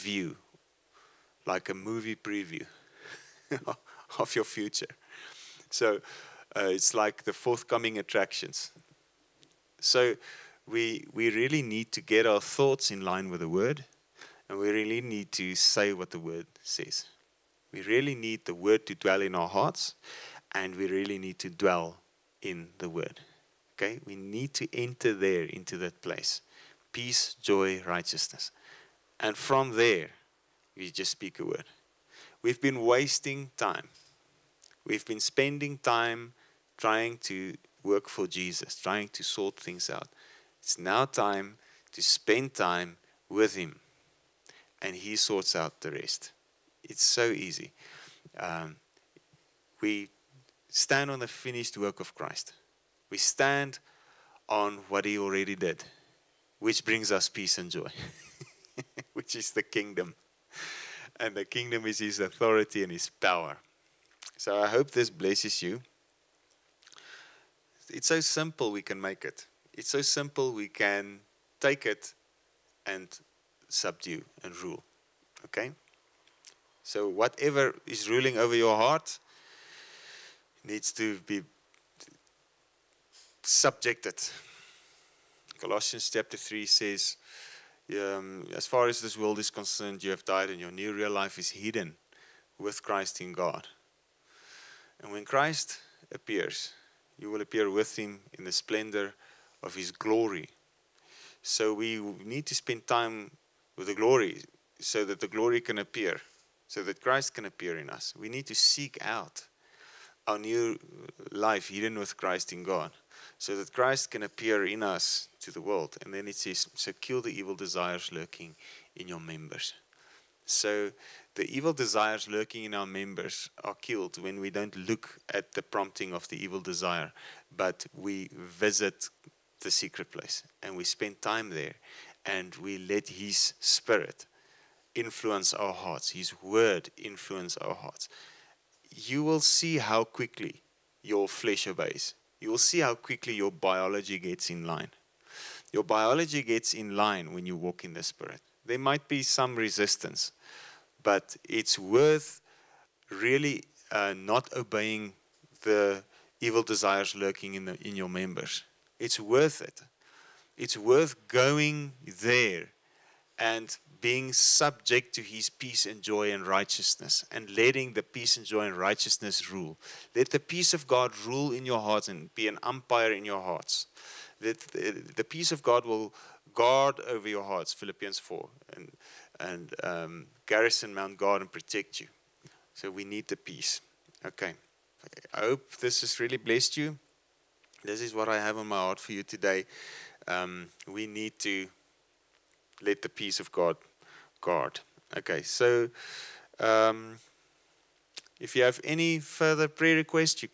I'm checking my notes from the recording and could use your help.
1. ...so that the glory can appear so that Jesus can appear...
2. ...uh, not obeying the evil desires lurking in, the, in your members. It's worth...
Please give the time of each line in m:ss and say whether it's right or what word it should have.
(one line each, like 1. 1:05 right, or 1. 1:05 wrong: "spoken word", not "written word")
1. 1:44 wrong: "Christ", not "Jesus"
2. 2:33 right.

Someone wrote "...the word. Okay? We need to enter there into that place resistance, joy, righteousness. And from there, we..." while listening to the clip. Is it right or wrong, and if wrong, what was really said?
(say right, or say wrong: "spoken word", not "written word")
wrong: "peace", not "resistance".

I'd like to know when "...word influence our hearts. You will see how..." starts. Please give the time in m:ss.
2:16.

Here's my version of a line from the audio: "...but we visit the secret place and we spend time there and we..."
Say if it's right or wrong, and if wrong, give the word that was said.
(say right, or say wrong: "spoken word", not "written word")
right.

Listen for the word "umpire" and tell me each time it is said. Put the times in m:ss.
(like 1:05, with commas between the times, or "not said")
2:52.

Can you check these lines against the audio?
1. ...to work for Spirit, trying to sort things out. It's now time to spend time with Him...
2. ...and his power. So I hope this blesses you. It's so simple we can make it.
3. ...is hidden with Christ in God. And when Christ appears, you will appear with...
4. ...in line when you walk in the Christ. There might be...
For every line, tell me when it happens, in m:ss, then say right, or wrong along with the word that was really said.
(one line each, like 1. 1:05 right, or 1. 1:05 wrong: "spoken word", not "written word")
1. 0:37 wrong: "Jesus", not "Spirit"
2. 1:02 right
3. 1:31 right
4. 2:26 wrong: "Spirit", not "Christ".